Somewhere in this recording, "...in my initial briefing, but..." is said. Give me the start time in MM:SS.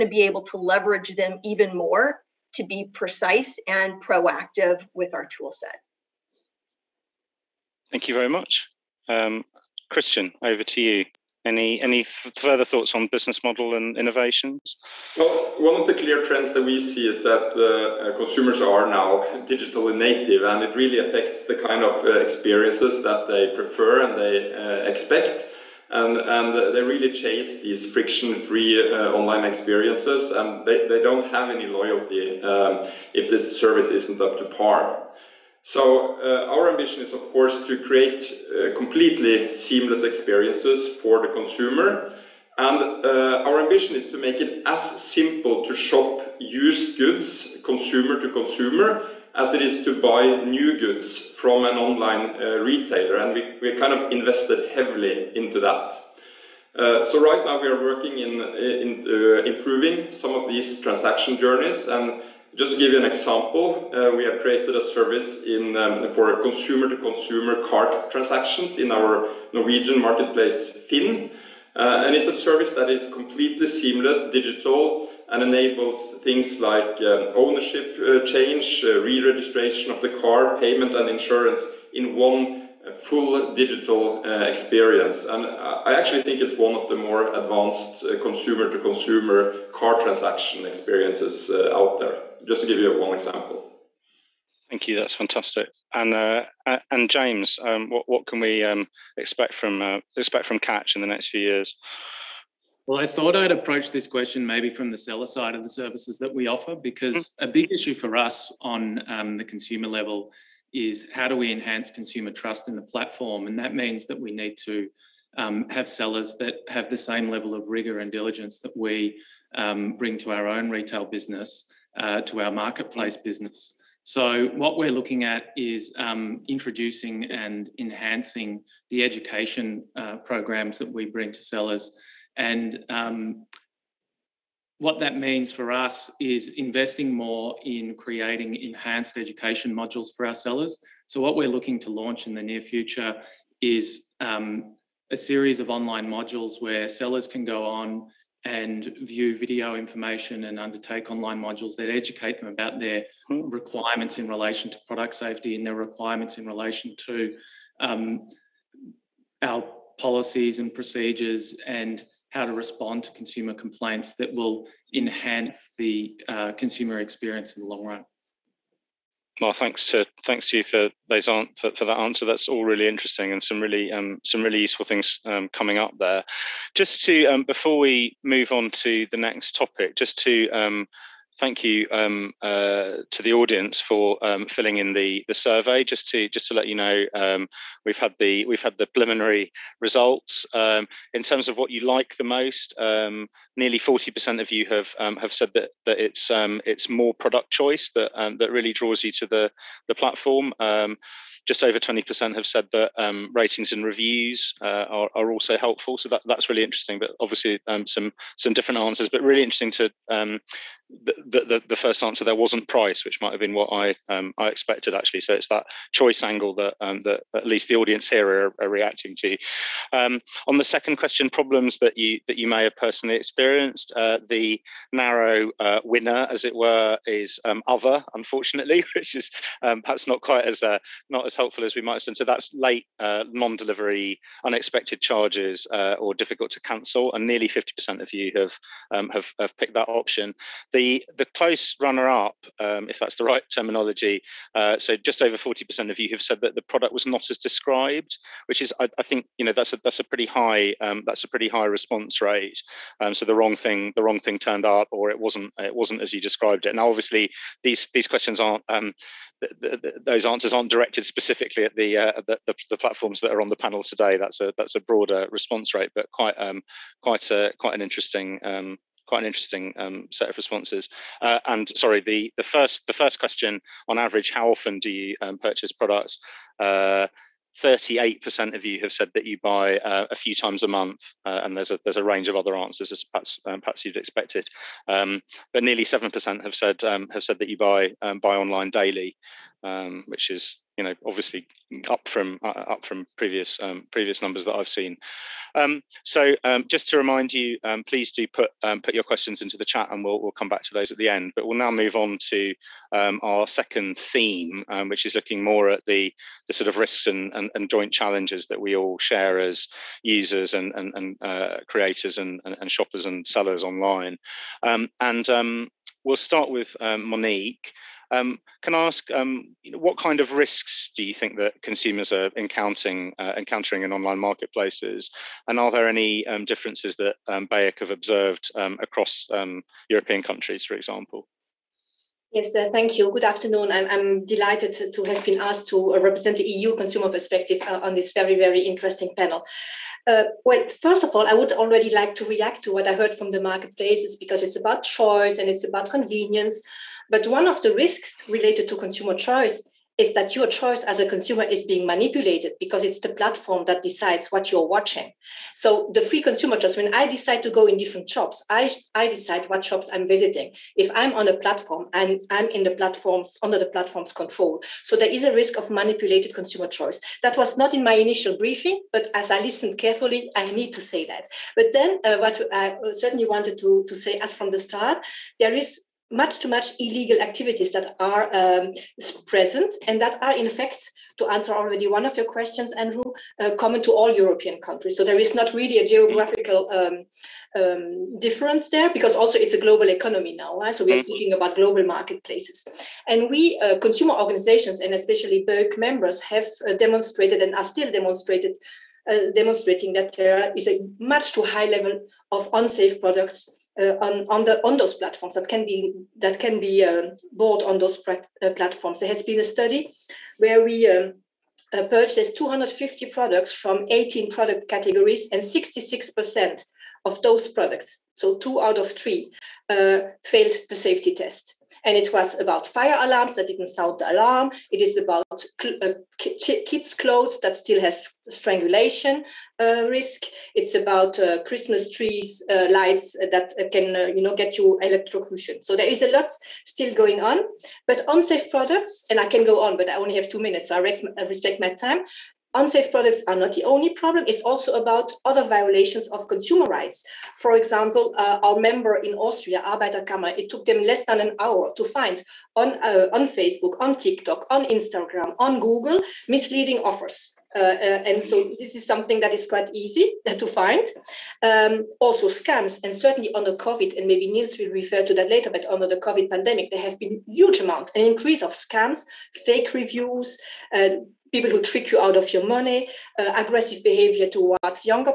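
06:07.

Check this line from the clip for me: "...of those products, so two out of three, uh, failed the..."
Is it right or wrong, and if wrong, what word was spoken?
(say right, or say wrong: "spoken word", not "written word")
right.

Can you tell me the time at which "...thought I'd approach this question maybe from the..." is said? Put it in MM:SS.
01:43.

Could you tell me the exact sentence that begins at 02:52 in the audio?
That's all really interesting and some really um, some really useful things um, coming up there.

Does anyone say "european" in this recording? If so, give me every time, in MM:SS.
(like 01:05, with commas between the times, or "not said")
05:29, 06:24.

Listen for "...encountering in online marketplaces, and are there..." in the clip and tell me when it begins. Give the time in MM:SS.
05:23.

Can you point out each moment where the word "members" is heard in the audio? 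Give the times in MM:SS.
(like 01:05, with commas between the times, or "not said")
06:35, 07:28.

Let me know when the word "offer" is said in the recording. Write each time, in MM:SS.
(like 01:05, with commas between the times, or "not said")
01:46, 07:36.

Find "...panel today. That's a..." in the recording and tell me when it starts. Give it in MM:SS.
04:23.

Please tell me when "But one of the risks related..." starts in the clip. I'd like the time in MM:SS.
05:47.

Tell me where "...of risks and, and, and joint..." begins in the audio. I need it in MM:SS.
05:06.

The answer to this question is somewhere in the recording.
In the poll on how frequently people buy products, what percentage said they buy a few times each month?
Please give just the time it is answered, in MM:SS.
04:37.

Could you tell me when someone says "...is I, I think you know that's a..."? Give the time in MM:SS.
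04:08.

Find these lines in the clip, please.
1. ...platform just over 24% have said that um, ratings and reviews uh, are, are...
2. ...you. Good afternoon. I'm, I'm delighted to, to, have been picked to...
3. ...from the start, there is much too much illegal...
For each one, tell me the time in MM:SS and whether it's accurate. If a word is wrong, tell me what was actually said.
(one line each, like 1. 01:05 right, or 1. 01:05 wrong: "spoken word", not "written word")
1. 03:19 wrong: "20", not "24"
2. 05:32 wrong: "asked", not "picked"
3. 06:14 right.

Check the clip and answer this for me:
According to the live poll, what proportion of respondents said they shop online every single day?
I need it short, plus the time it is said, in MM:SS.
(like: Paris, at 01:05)
7%, at 04:45.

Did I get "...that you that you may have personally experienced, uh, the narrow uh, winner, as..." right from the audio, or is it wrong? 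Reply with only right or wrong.
right.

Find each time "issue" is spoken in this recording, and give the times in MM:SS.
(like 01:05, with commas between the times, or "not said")
01:47.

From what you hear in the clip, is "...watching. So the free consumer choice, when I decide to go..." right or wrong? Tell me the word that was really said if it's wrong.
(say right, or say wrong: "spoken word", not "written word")
right.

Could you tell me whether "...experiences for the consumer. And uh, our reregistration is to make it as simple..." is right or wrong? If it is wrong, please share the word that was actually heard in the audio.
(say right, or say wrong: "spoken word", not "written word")
wrong: "ambition", not "reregistration".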